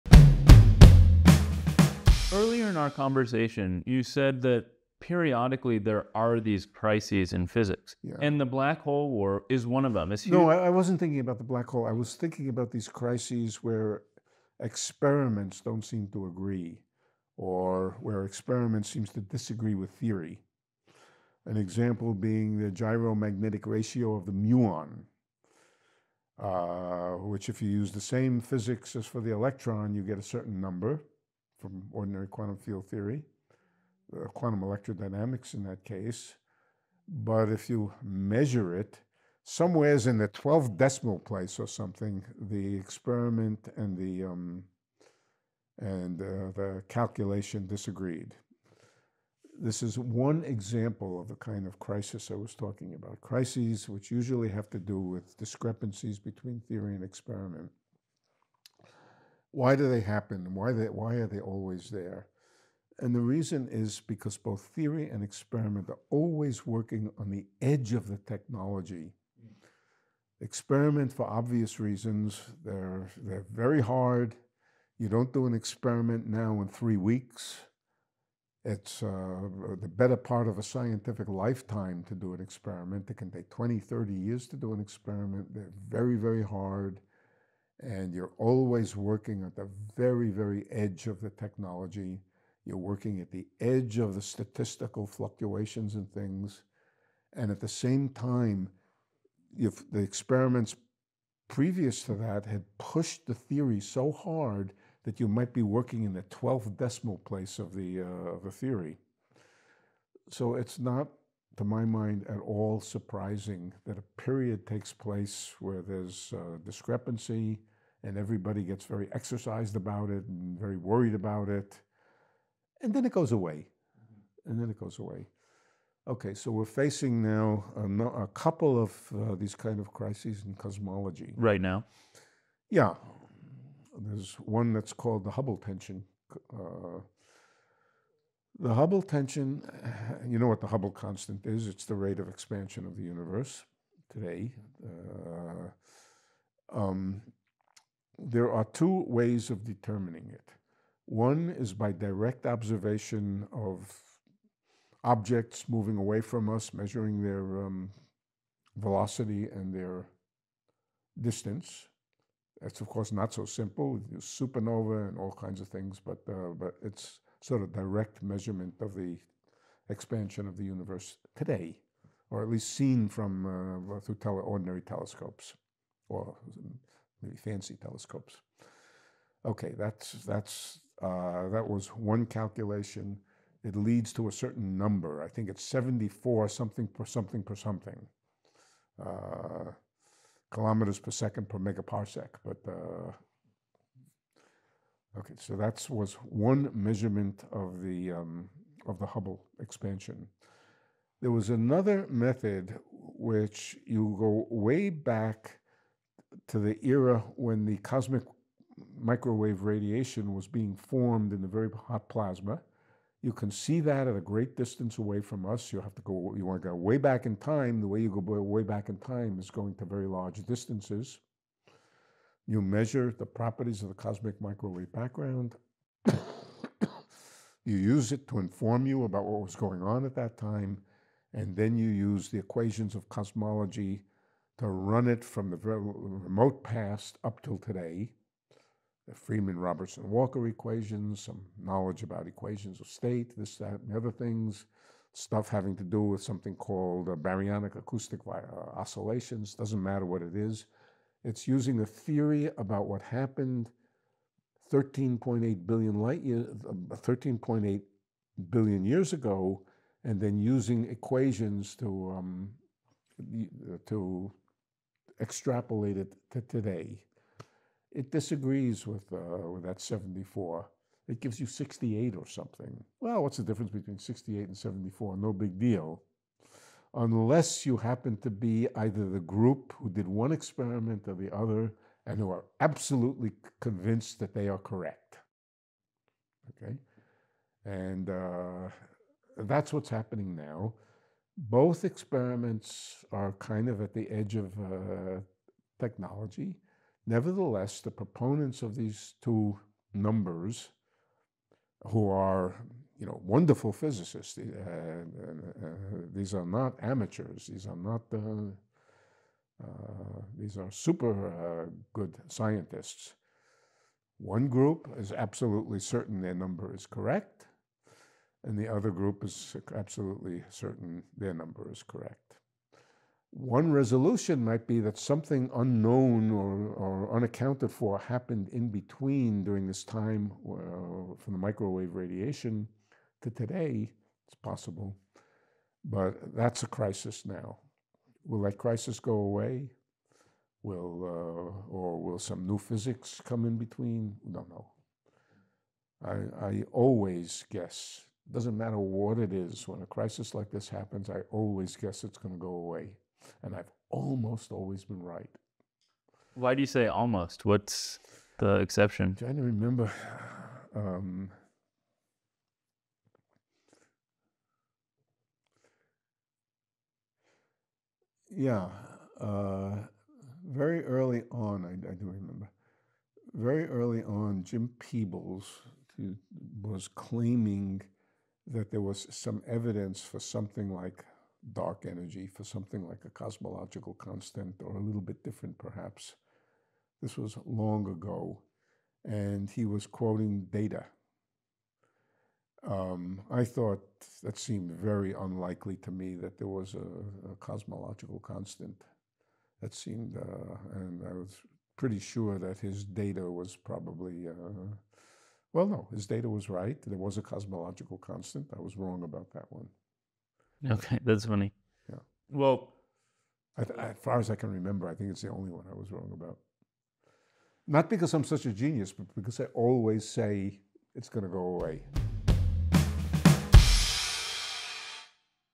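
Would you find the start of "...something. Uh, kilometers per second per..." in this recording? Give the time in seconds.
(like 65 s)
187 s.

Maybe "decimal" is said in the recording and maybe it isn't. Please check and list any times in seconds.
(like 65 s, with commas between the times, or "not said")
40 s, 106 s.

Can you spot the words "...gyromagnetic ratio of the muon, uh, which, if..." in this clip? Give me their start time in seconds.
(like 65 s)
22 s.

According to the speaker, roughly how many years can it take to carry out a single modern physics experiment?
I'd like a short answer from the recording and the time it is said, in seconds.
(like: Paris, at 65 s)
20 to 30 years, at 83 s.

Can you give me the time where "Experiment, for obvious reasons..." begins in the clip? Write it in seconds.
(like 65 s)
70 s.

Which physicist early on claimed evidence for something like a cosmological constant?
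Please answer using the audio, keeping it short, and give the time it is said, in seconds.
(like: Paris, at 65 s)
Jim Peebles, at 374 s.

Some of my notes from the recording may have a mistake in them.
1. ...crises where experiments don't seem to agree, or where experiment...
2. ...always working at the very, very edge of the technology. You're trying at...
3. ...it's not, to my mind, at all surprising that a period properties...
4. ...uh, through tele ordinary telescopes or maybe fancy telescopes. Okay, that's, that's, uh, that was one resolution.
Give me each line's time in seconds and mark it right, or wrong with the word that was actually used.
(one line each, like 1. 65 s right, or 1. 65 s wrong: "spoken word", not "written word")
1. 12 s right
2. 88 s wrong: "working", not "trying"
3. 110 s wrong: "takes", not "properties"
4. 173 s wrong: "calculation", not "resolution".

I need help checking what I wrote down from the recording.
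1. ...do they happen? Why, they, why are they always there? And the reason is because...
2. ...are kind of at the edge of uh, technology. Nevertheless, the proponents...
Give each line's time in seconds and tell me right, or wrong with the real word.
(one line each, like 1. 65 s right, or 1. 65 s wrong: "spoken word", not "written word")
1. 59 s right
2. 293 s right.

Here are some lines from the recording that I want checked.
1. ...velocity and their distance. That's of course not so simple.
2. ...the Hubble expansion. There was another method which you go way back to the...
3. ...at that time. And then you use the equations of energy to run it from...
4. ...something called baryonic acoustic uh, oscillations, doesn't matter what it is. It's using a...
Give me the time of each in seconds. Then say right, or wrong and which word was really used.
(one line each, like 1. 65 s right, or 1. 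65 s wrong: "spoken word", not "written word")
1. 158 s right
2. 198 s right
3. 230 s wrong: "cosmology", not "energy"
4. 246 s right.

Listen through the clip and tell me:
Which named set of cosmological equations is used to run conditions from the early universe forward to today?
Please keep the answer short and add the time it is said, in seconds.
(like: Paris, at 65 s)
Friedmann Robertson Walker equations, at 239 s.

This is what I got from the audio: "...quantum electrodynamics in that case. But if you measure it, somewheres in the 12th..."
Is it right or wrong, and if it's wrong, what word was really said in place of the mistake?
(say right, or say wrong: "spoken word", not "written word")
right.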